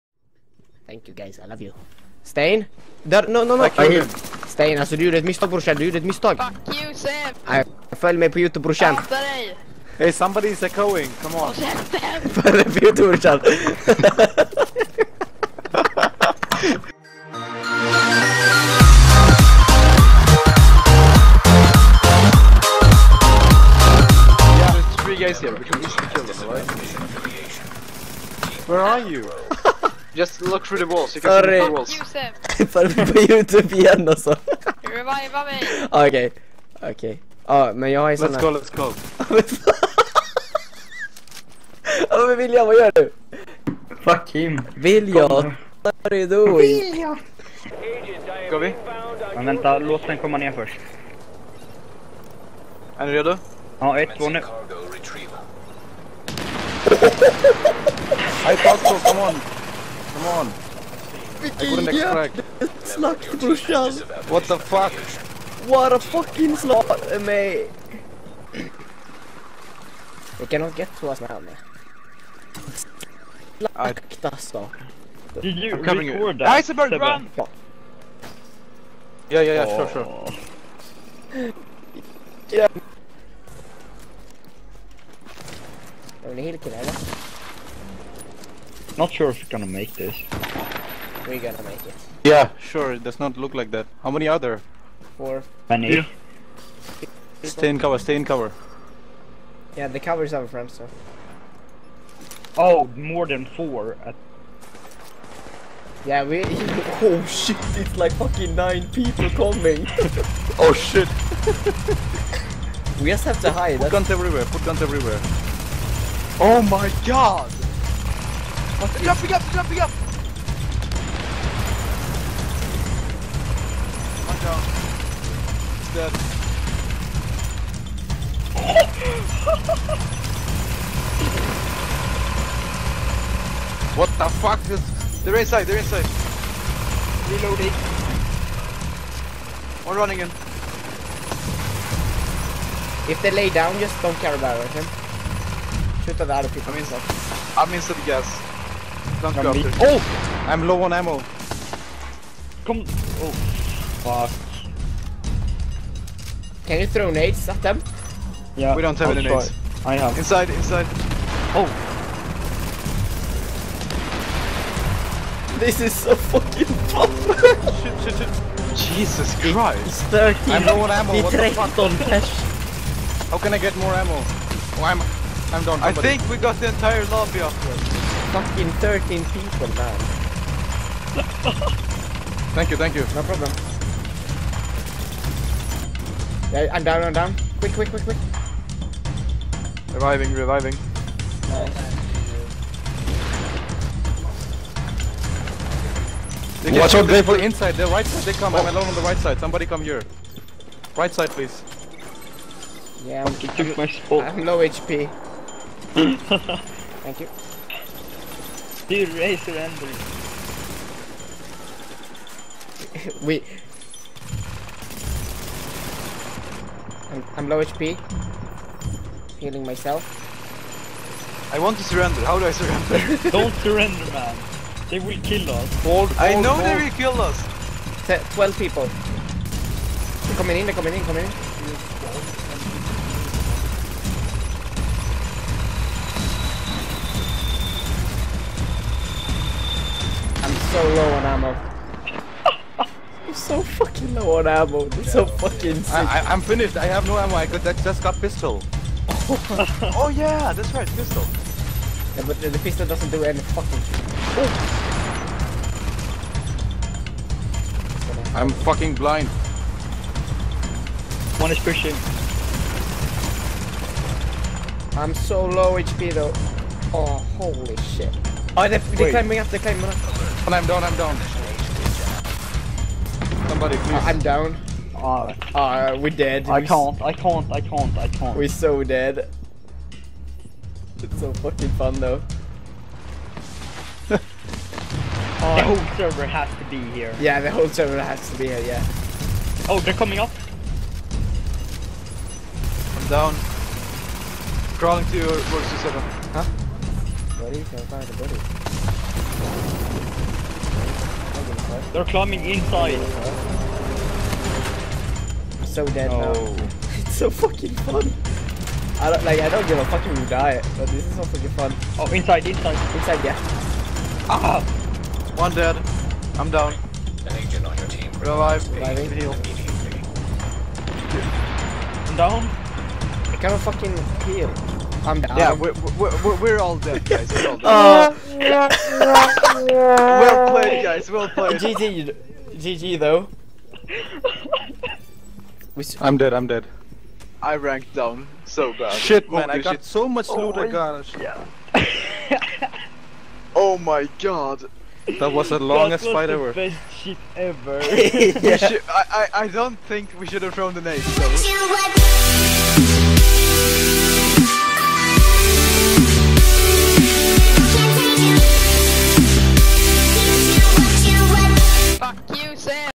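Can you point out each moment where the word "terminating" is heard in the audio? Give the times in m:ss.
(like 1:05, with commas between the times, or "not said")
not said.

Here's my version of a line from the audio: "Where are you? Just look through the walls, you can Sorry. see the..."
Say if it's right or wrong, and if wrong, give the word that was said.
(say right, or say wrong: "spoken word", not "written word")
right.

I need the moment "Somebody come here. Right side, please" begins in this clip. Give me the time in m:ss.
3:19.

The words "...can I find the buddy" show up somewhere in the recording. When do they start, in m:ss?
4:57.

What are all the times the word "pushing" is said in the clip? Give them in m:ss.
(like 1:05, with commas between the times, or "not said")
4:21.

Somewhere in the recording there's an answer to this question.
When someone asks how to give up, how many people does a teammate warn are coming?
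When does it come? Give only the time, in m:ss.
3:48.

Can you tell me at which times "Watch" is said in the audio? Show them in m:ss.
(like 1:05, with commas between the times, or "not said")
3:16.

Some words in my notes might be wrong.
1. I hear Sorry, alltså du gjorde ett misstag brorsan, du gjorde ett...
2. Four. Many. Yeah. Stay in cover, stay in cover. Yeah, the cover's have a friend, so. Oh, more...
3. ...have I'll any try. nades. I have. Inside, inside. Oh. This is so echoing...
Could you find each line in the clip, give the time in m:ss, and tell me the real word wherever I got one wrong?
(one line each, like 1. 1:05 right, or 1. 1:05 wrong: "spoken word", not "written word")
1. 0:03 wrong: "Stain", not "Sorry"
2. 1:35 right
3. 2:38 wrong: "fucking", not "echoing".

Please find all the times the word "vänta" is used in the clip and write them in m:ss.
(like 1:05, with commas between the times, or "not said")
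0:49.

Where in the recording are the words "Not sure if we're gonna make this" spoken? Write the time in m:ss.
1:28.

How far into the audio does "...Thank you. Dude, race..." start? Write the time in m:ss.
3:27.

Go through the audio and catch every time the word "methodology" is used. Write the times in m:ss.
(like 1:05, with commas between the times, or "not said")
not said.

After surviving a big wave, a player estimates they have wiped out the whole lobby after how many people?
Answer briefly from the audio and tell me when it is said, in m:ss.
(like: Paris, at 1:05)
13, at 2:58.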